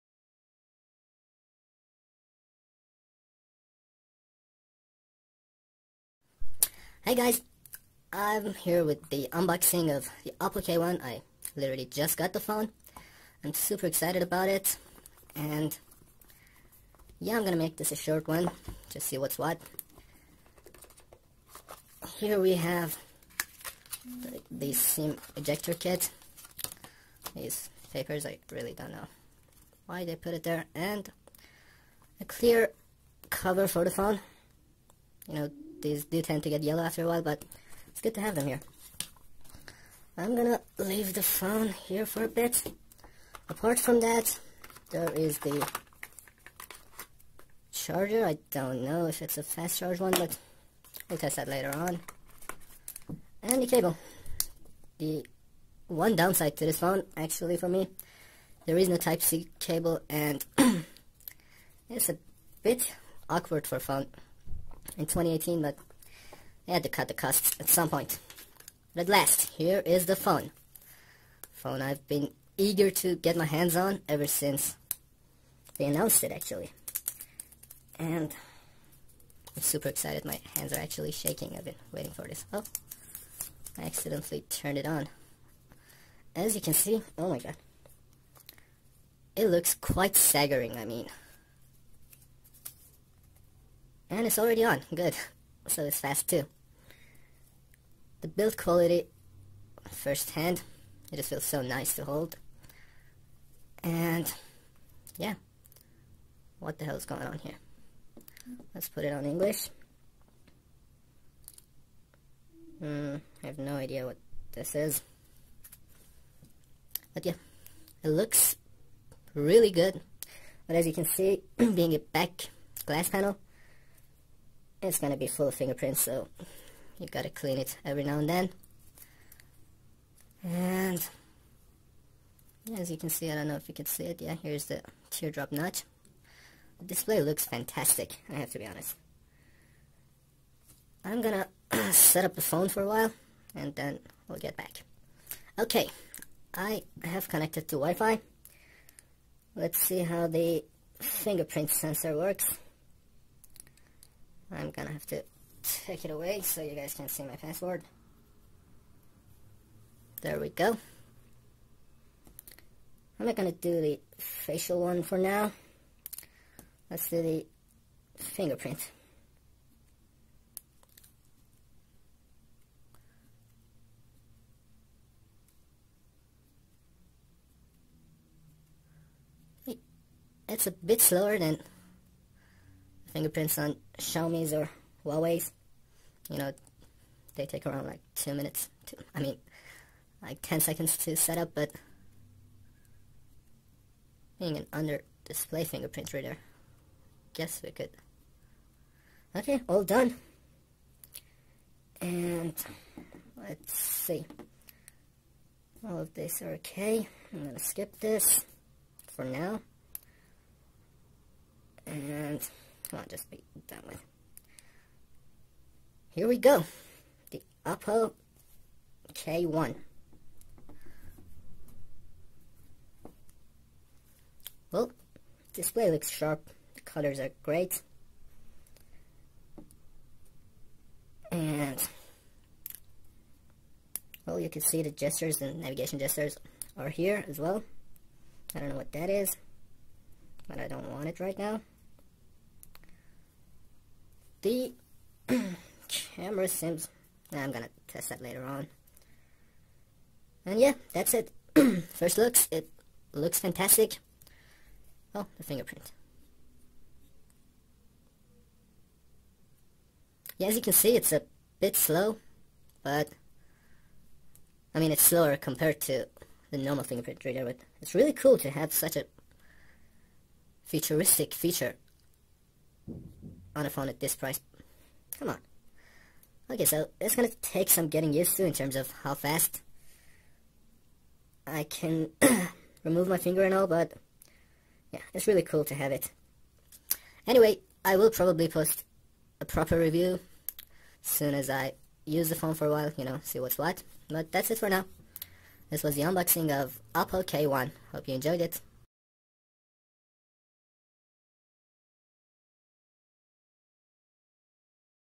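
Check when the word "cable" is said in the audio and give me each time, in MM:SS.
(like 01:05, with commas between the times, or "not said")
00:53, 00:59.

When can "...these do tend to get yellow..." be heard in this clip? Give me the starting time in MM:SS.
00:35.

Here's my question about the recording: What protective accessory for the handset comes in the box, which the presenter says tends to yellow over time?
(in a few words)
Clear cover.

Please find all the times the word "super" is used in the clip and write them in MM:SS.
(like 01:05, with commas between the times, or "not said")
00:13, 01:19.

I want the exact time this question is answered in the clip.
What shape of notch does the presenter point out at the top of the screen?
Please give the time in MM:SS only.
02:15.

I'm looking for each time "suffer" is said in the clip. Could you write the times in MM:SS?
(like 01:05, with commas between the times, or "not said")
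not said.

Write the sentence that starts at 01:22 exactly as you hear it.
Oh, I accidentally turned it on.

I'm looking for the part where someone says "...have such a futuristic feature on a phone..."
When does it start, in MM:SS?
04:28.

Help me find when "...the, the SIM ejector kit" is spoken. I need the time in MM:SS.
00:24.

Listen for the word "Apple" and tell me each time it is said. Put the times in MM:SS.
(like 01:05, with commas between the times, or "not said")
04:56.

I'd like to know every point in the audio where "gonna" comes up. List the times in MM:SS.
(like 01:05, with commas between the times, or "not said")
00:17, 00:40, 02:04, 02:21, 02:34, 02:43, 03:27, 04:07.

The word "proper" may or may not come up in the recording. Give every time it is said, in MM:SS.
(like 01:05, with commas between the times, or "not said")
04:49.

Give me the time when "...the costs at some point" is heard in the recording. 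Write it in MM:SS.
01:07.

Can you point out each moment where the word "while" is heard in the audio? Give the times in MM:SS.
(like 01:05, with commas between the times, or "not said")
00:37, 02:22, 04:52.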